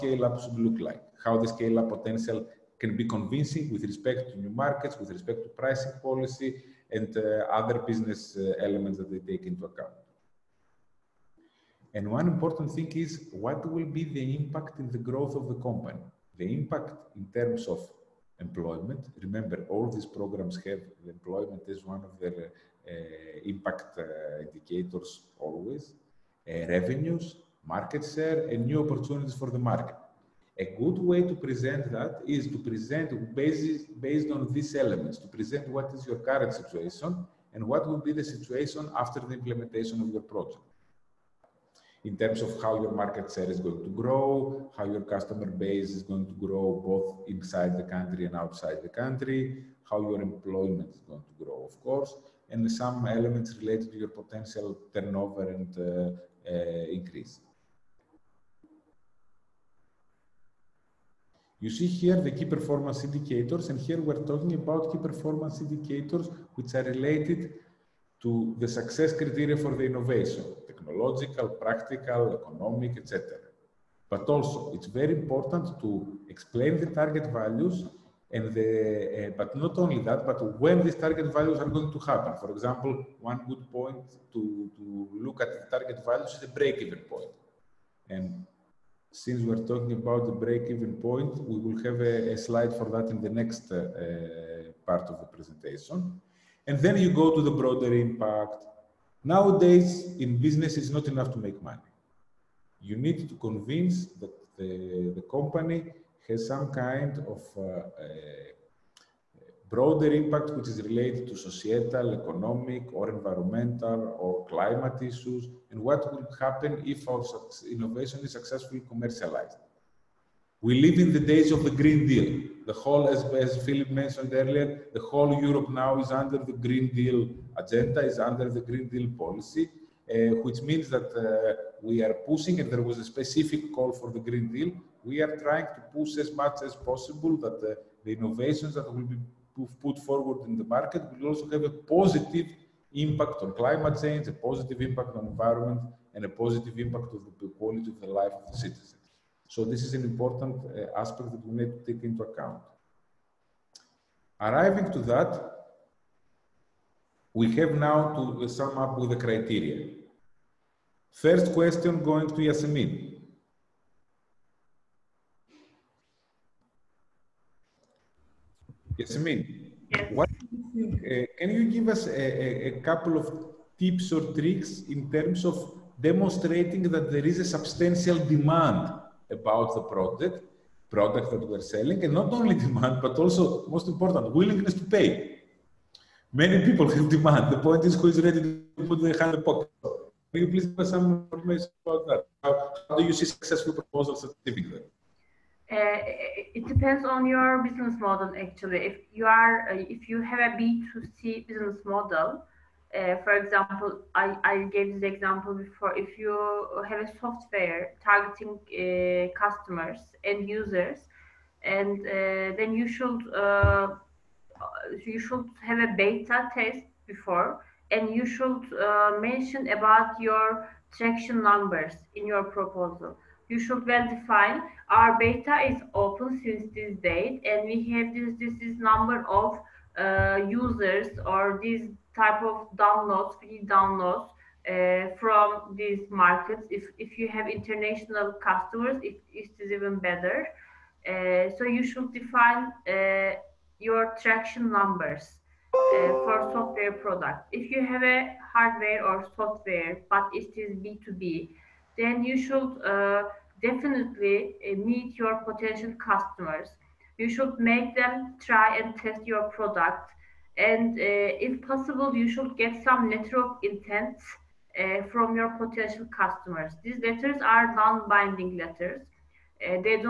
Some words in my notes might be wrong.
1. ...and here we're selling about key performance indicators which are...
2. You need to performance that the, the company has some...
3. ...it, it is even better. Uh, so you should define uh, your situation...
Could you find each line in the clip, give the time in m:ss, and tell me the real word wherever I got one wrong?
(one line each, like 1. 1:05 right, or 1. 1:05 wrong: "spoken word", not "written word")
1. 1:03 wrong: "talking", not "selling"
2. 1:42 wrong: "convince", not "performance"
3. 3:59 wrong: "traction", not "situation".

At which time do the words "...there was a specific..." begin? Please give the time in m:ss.
2:12.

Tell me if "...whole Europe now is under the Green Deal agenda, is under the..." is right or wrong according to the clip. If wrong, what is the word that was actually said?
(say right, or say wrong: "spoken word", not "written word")
right.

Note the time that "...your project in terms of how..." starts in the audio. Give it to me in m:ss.
0:40.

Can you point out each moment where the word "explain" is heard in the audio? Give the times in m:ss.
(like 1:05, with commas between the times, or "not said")
1:16.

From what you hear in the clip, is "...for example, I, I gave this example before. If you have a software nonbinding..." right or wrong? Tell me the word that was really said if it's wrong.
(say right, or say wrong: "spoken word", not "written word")
wrong: "targeting", not "nonbinding".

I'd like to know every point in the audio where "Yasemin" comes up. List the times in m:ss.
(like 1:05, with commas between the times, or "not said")
2:42, 2:48.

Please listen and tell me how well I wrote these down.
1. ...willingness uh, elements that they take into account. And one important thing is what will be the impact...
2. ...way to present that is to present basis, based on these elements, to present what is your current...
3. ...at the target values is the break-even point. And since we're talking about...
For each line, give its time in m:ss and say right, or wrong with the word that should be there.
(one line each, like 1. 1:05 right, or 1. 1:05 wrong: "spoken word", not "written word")
1. 0:07 wrong: "business", not "willingness"
2. 0:30 right
3. 1:25 right.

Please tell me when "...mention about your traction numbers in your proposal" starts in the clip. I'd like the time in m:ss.
3:39.